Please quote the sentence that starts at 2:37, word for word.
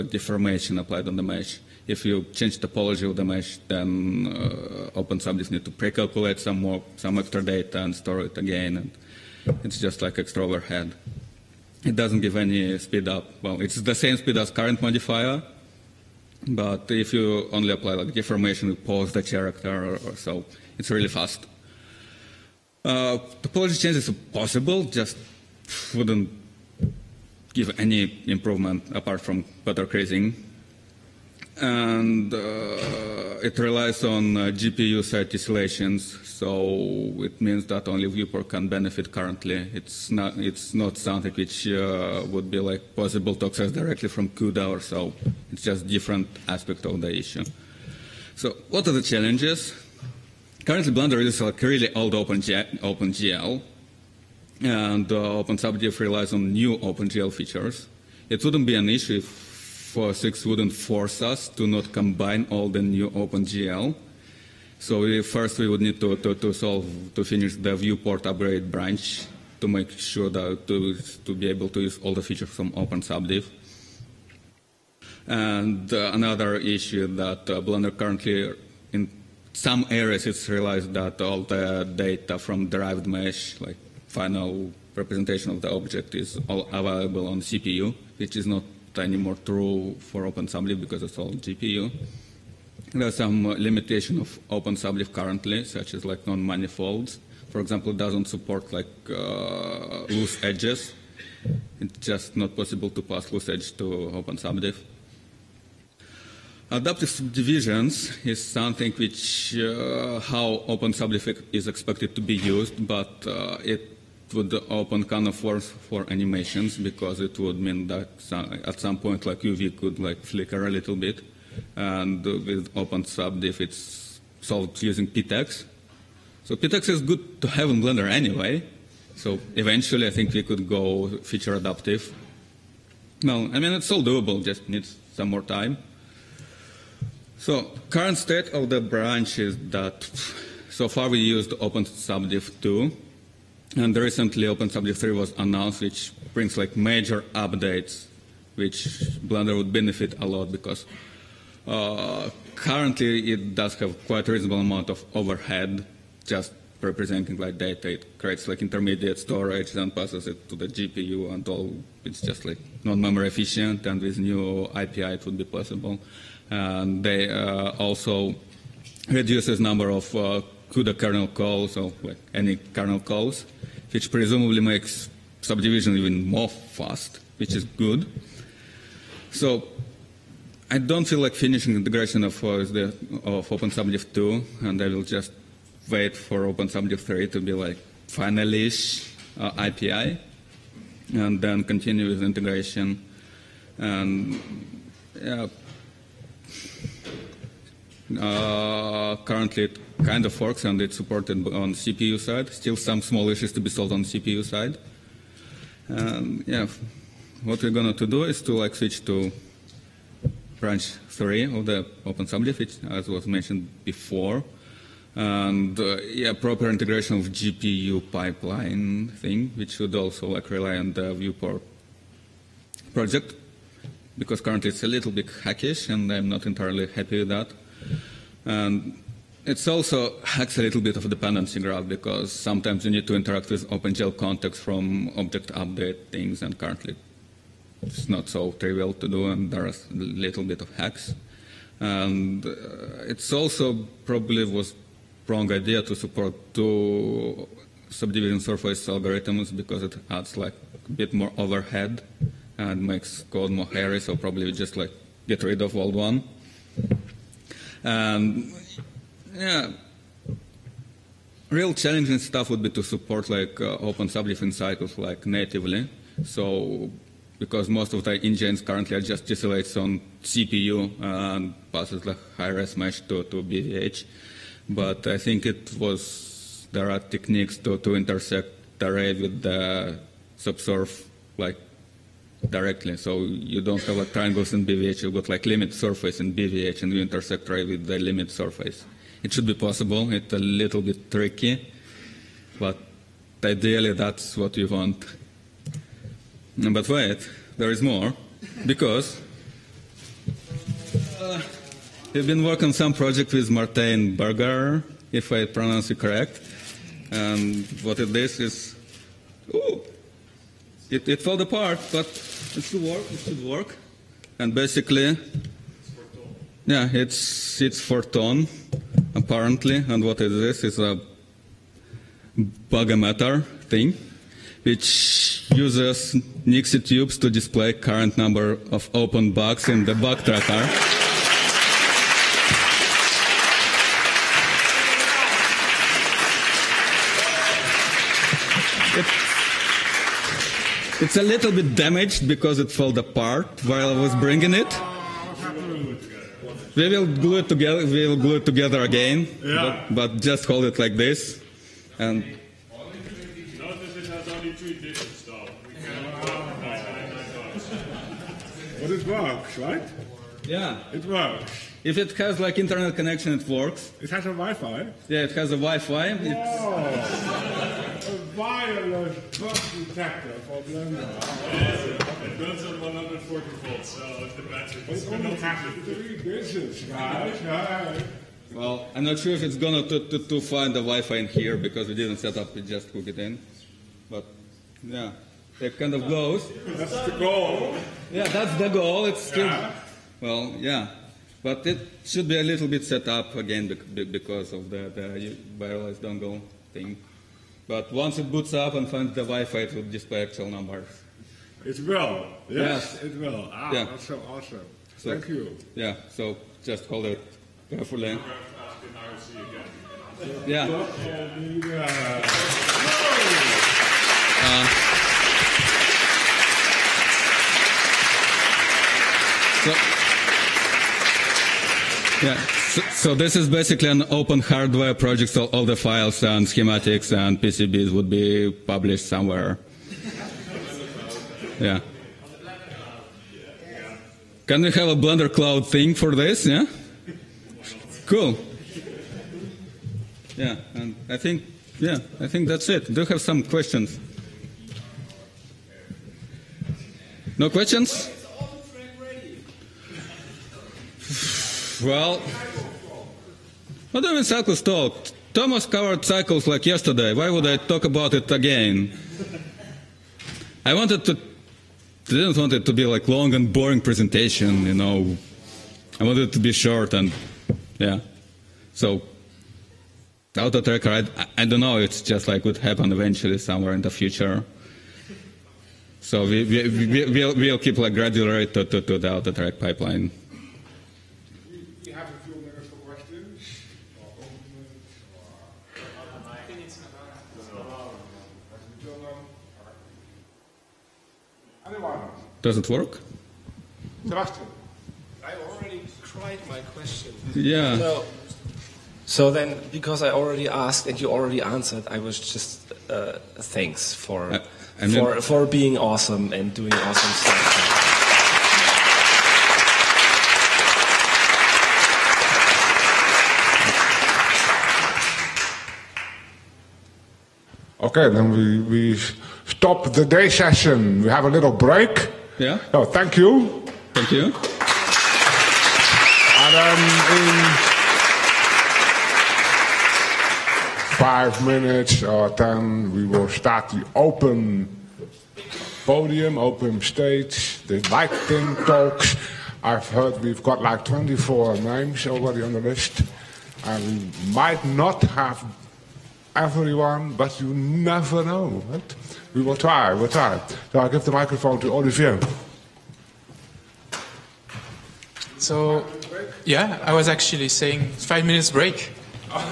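It creates like intermediate storage, and passes it to the GPU and all.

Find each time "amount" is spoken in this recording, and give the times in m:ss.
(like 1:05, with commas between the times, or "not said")
2:34.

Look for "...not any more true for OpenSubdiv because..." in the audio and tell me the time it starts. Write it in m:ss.
1:28.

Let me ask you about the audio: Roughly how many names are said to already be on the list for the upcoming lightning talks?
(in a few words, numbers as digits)
24.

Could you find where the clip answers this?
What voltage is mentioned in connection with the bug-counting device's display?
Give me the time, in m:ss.
6:12.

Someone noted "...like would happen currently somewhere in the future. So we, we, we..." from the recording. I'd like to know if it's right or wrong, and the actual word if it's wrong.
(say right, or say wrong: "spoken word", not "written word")
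wrong: "eventually", not "currently".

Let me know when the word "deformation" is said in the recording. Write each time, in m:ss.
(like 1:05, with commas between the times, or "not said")
0:00, 0:18.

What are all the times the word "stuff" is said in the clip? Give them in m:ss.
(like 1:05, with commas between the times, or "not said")
4:22, 8:27.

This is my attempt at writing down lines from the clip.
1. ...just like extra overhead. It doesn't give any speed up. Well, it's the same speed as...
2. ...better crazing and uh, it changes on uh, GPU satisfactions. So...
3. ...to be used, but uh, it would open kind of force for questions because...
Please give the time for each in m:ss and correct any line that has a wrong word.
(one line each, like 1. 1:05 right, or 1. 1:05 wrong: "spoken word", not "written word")
1. 0:09 right
2. 0:29 wrong: "relies", not "changes"
3. 1:52 wrong: "animations", not "questions".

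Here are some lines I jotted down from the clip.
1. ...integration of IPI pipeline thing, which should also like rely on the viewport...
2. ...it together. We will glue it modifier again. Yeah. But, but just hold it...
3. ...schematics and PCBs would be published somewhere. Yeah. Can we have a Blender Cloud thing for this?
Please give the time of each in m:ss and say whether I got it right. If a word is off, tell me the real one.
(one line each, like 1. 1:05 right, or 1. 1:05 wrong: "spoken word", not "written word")
1. 3:36 wrong: "GPU", not "IPI"
2. 5:47 wrong: "together", not "modifier"
3. 7:06 right.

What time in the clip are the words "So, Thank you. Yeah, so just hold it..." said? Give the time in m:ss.
6:44.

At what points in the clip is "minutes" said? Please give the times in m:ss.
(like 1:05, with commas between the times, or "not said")
8:51, 9:18.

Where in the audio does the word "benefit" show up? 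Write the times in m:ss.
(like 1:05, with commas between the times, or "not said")
0:38, 2:29.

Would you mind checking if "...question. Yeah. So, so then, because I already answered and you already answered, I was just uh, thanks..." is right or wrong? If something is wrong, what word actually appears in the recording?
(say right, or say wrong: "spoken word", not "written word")
wrong: "asked", not "answered".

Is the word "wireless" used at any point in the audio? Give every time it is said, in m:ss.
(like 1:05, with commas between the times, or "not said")
6:08, 6:35.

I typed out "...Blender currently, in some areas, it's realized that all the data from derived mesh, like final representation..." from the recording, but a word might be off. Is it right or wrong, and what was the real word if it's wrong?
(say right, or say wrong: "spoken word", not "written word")
right.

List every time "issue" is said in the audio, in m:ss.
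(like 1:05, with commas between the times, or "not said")
0:47, 0:58, 1:16, 3:23.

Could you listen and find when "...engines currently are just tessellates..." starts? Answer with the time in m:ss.
4:28.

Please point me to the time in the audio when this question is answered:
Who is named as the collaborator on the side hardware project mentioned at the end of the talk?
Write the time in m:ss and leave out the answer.
5:03.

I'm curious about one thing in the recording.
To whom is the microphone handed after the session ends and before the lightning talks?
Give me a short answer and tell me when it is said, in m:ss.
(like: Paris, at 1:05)
Olivier, at 9:11.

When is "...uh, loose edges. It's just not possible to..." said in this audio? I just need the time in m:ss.
1:39.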